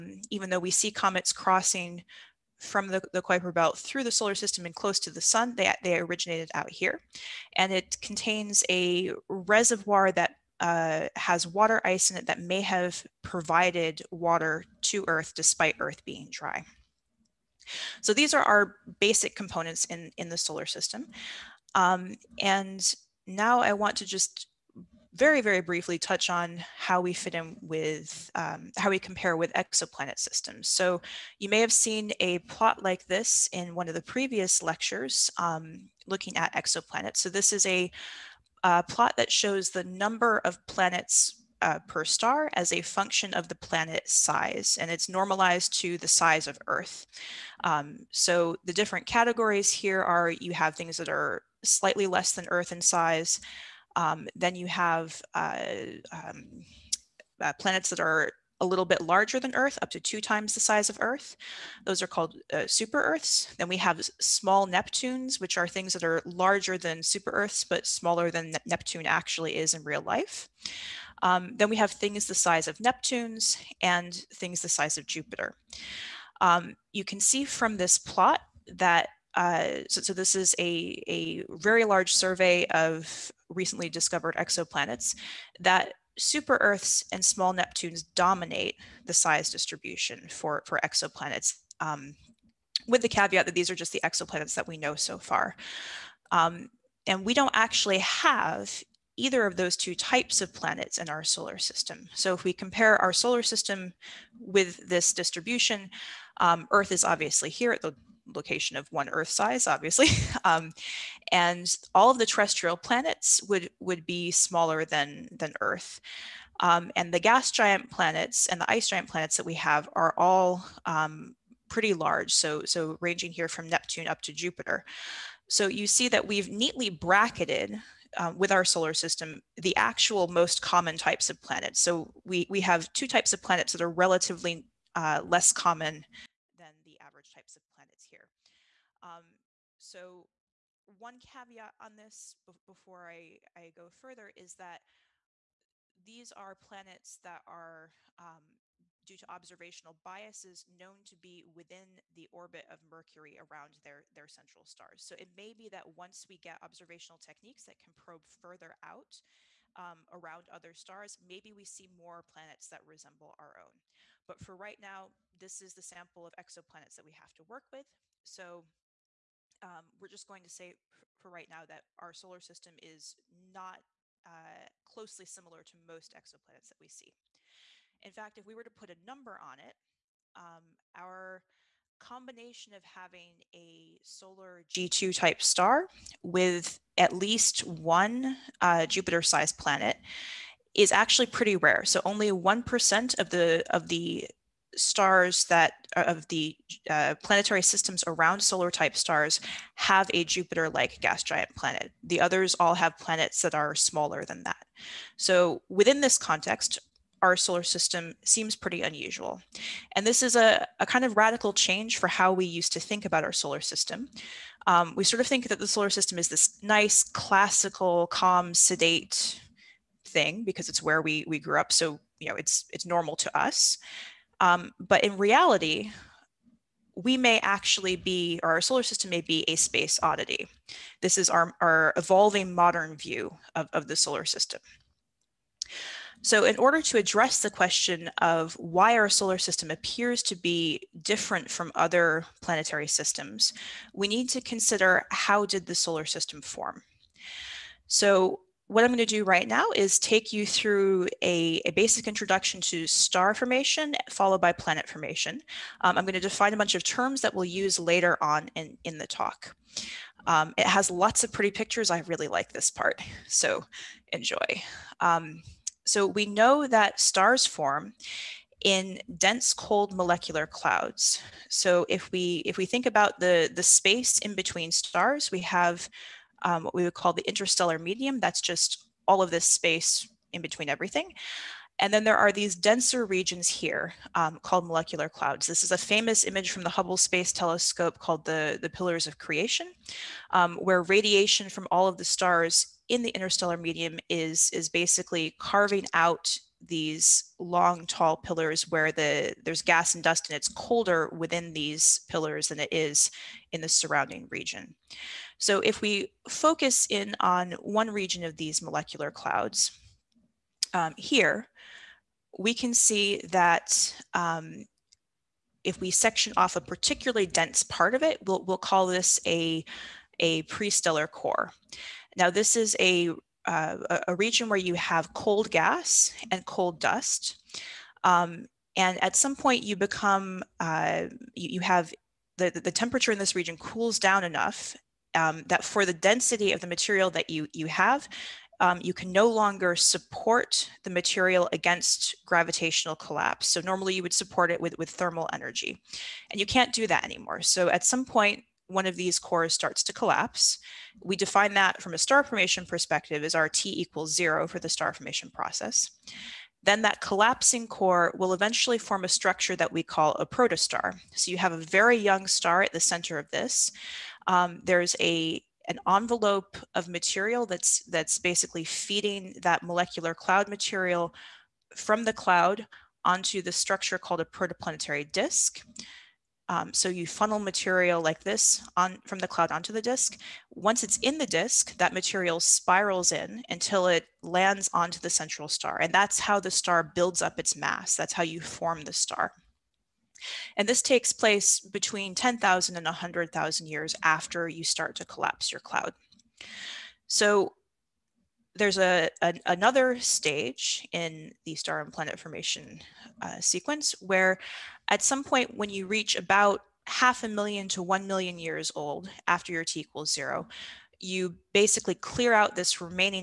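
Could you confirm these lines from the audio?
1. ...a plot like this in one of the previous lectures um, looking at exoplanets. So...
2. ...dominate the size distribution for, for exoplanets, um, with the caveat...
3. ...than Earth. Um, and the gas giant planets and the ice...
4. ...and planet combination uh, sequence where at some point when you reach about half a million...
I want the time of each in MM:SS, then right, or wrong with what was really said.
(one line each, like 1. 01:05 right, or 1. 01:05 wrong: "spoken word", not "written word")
1. 00:32 right
2. 01:28 right
3. 01:55 right
4. 06:41 wrong: "formation", not "combination".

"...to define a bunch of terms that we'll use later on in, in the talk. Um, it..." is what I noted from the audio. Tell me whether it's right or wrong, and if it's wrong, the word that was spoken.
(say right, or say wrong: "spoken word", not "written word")
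right.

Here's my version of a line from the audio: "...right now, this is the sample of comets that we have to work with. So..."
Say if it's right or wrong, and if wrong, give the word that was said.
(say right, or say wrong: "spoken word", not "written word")
wrong: "exoplanets", not "comets".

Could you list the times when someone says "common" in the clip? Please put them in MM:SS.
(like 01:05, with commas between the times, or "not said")
02:10, 02:15.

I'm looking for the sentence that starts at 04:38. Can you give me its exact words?
That's just all of this space in between everything.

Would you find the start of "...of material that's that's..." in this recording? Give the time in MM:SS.
06:06.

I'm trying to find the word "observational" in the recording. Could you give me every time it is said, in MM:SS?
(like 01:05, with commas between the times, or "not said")
02:29, 02:36.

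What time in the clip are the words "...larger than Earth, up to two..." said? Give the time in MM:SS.
00:59.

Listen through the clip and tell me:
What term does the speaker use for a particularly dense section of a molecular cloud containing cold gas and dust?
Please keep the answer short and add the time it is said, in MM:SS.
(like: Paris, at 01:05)
Prestellar core, at 05:20.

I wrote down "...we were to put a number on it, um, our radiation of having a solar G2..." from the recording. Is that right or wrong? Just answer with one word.
wrong.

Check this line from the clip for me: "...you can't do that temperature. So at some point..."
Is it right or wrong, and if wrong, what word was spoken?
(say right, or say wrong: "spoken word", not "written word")
wrong: "anymore", not "temperature".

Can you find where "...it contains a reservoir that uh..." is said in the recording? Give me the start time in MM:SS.
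00:07.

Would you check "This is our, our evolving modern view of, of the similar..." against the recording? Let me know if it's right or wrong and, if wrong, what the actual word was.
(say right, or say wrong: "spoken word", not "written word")
wrong: "solar", not "similar".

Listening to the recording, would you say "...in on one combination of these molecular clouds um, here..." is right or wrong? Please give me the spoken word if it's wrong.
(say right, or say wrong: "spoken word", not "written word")
wrong: "region", not "combination".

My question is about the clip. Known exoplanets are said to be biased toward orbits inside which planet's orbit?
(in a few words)
Mercury.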